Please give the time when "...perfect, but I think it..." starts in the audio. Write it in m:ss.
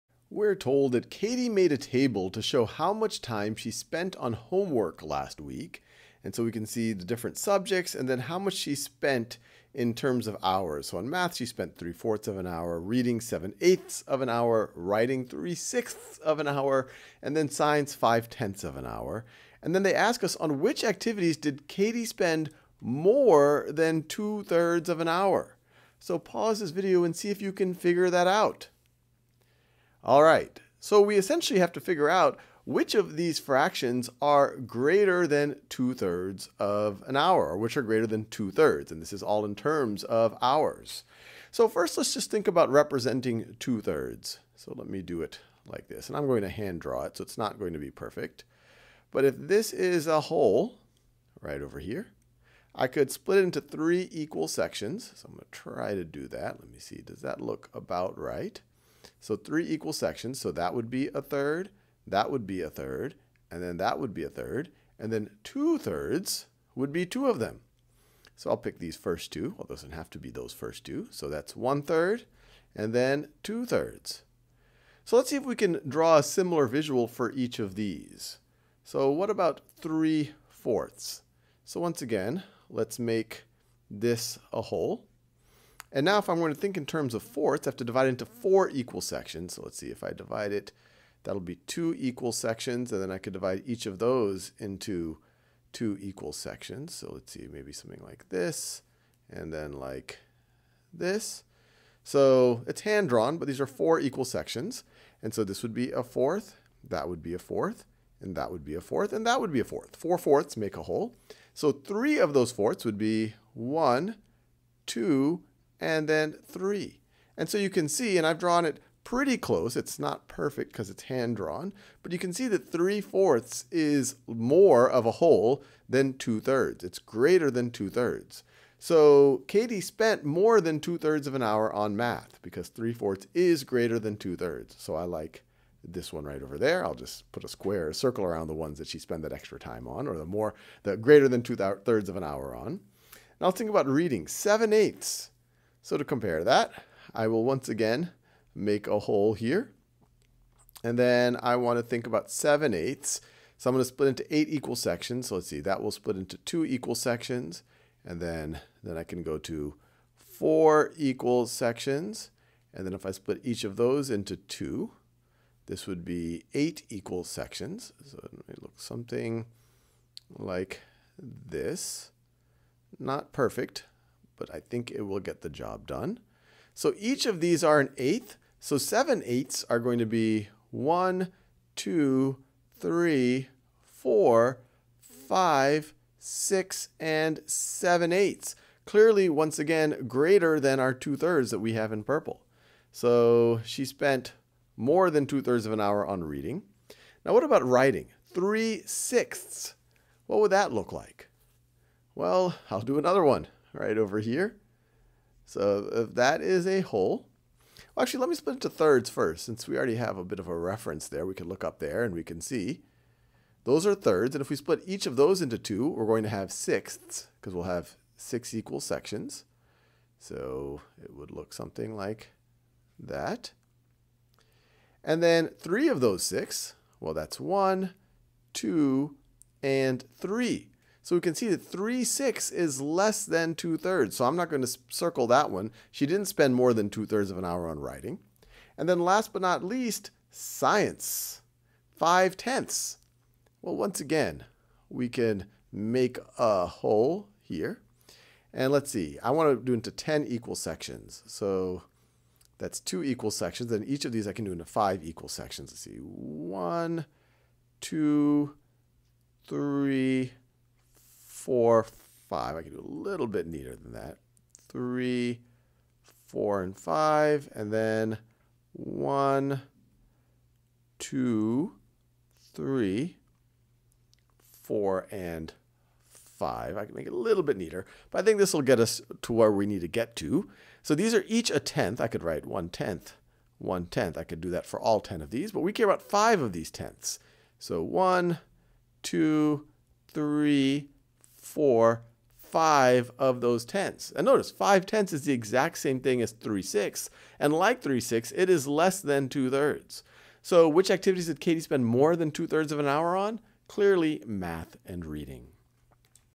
2:53.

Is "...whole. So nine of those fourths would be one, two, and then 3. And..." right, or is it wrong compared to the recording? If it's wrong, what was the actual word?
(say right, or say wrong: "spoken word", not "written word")
wrong: "three", not "nine".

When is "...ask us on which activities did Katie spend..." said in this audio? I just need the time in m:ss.
0:19.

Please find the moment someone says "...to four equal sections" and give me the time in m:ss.
2:39.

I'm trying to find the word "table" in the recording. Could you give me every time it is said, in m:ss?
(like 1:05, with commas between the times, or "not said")
0:01.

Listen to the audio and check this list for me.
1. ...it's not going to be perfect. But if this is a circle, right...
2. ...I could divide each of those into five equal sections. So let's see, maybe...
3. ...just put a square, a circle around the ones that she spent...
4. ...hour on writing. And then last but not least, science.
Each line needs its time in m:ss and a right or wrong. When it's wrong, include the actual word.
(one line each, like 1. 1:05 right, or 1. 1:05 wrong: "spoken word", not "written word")
1. 0:47 wrong: "whole", not "circle"
2. 1:33 wrong: "two", not "five"
3. 2:16 right
4. 3:57 right.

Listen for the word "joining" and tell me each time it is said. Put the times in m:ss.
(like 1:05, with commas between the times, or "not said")
not said.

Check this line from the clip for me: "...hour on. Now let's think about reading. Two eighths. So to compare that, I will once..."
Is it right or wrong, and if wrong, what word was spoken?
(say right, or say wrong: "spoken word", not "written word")
wrong: "Seven", not "Two".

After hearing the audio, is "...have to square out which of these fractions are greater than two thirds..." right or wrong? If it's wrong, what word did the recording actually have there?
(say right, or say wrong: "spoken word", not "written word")
wrong: "figure", not "square".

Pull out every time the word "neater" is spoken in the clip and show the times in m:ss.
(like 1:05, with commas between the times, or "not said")
4:23, 4:37.